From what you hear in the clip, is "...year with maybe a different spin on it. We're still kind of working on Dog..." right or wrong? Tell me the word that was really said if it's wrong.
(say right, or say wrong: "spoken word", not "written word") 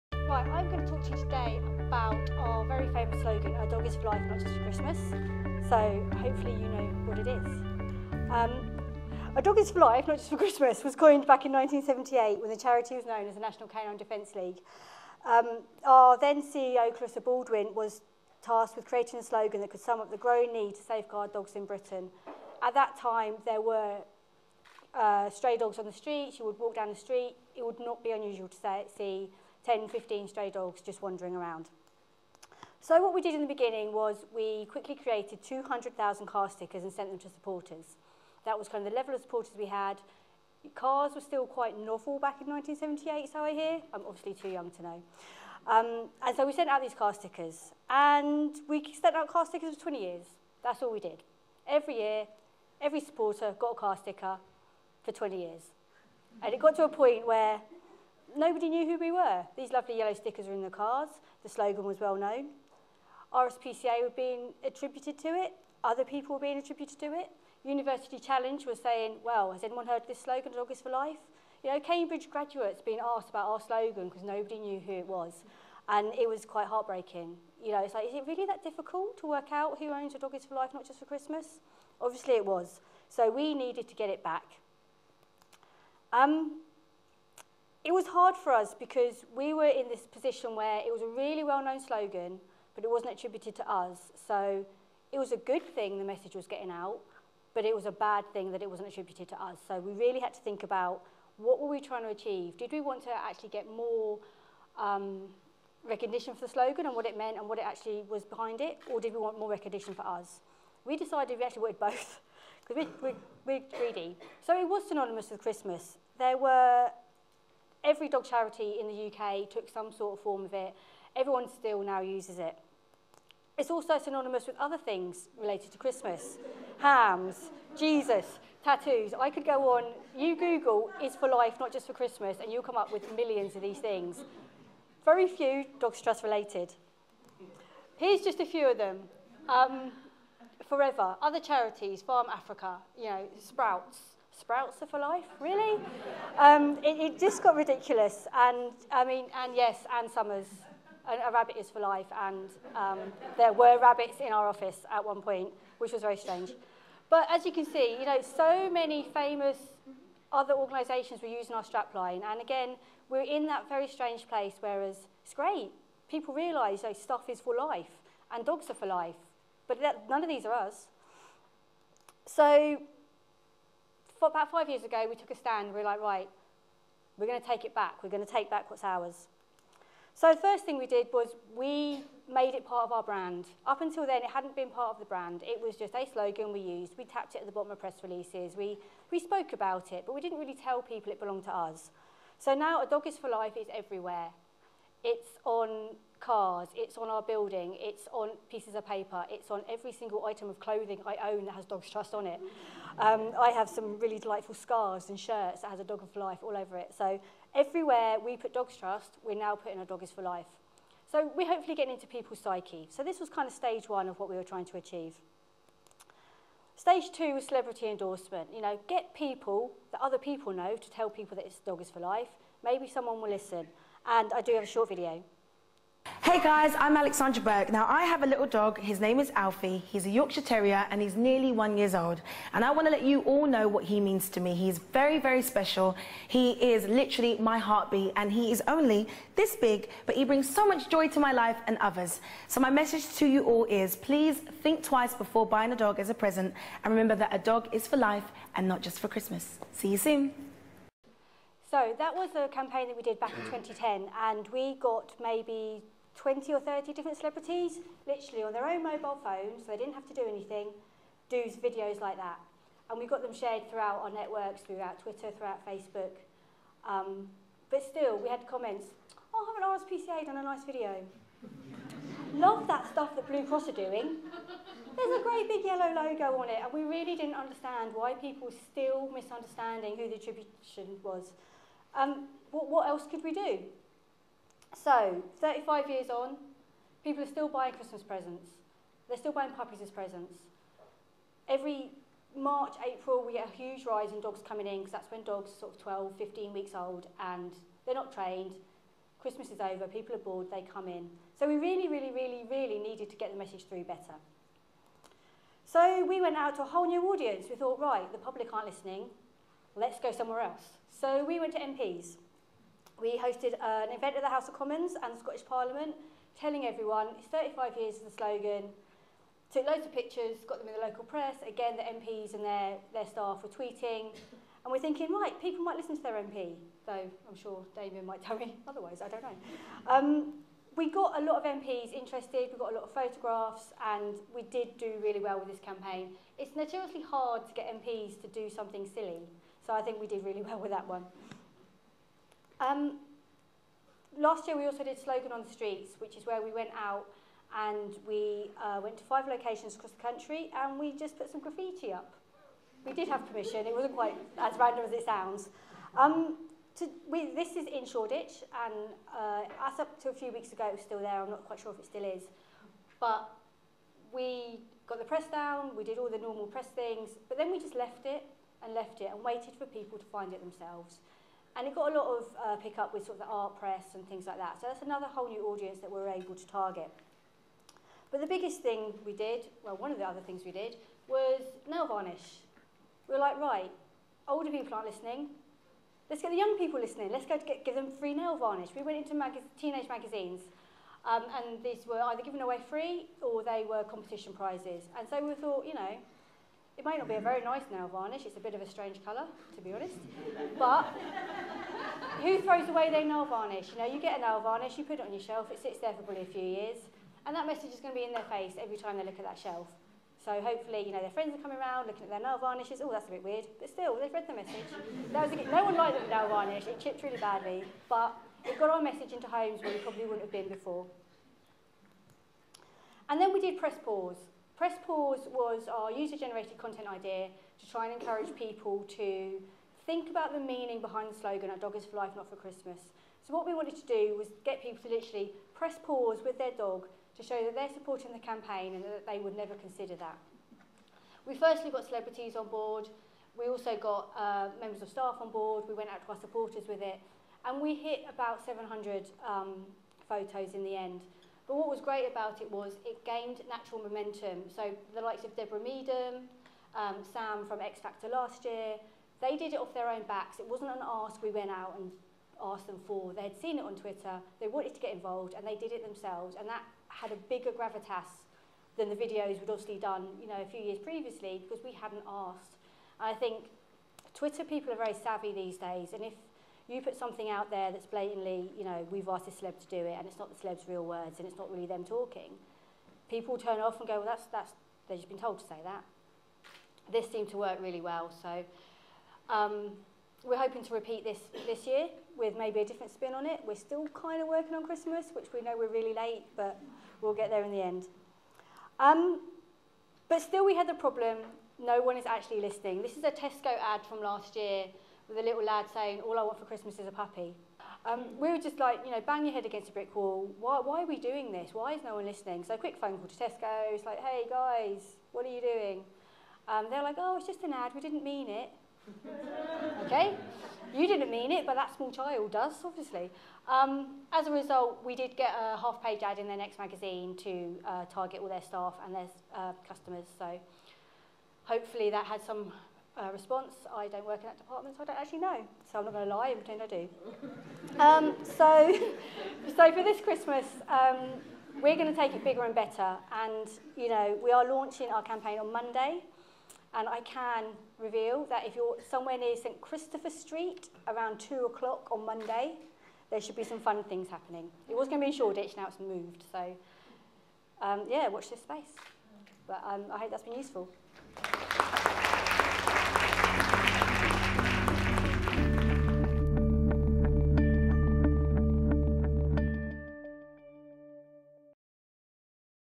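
wrong: "Christmas", not "Dog".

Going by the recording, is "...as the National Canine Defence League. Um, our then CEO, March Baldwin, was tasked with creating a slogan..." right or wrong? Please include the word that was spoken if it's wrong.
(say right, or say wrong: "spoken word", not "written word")
wrong: "Clarissa", not "March".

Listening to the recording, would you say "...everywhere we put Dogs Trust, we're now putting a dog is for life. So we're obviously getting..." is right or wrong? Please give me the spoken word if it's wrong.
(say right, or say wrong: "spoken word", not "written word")
wrong: "hopefully", not "obviously".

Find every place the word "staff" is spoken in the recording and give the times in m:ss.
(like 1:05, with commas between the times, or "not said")
5:23, 7:24, 8:48.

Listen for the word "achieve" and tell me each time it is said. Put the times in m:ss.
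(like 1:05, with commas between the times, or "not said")
1:42, 3:34.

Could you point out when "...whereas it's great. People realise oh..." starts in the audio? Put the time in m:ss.
2:44.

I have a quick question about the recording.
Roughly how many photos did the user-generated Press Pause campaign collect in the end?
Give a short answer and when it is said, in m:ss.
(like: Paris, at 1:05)
700, at 7:28.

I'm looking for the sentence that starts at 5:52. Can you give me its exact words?
We did have permission, it wasn't quite as random as it sounds.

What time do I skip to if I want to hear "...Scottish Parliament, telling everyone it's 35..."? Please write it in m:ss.
5:15.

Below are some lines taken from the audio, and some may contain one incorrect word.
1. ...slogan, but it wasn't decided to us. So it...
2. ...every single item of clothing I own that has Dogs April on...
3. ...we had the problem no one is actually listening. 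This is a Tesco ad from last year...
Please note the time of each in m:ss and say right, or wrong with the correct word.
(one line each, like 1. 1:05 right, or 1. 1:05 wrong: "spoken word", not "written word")
1. 1:31 wrong: "attributed", not "decided"
2. 3:19 wrong: "Trust", not "April"
3. 8:20 right.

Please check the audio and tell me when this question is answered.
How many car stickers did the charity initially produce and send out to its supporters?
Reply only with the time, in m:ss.
0:35.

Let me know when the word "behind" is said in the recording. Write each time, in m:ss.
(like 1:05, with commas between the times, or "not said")
1:48, 7:10.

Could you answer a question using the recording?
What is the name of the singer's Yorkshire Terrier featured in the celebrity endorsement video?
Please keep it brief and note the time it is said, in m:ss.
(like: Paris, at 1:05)
Alfie, at 3:49.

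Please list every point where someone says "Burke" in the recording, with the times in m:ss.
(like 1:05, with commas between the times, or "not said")
3:47.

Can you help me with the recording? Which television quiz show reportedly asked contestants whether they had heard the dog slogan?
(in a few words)
University Challenge.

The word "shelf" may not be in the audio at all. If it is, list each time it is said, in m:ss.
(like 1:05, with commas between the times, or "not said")
6:45, 6:49.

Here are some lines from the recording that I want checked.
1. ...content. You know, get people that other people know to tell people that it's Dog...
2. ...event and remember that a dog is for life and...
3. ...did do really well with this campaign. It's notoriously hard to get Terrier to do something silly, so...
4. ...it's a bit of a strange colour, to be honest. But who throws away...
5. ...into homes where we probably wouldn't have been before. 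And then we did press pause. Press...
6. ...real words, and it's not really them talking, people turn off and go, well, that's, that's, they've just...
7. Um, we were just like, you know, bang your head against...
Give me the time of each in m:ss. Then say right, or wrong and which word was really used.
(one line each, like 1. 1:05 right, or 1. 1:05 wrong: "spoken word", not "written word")
1. 3:37 wrong: "endorsement", not "content"
2. 4:06 wrong: "present", not "event"
3. 5:34 wrong: "MPs", not "Terrier"
4. 6:38 right
5. 6:59 right
6. 8:00 right
7. 8:27 right.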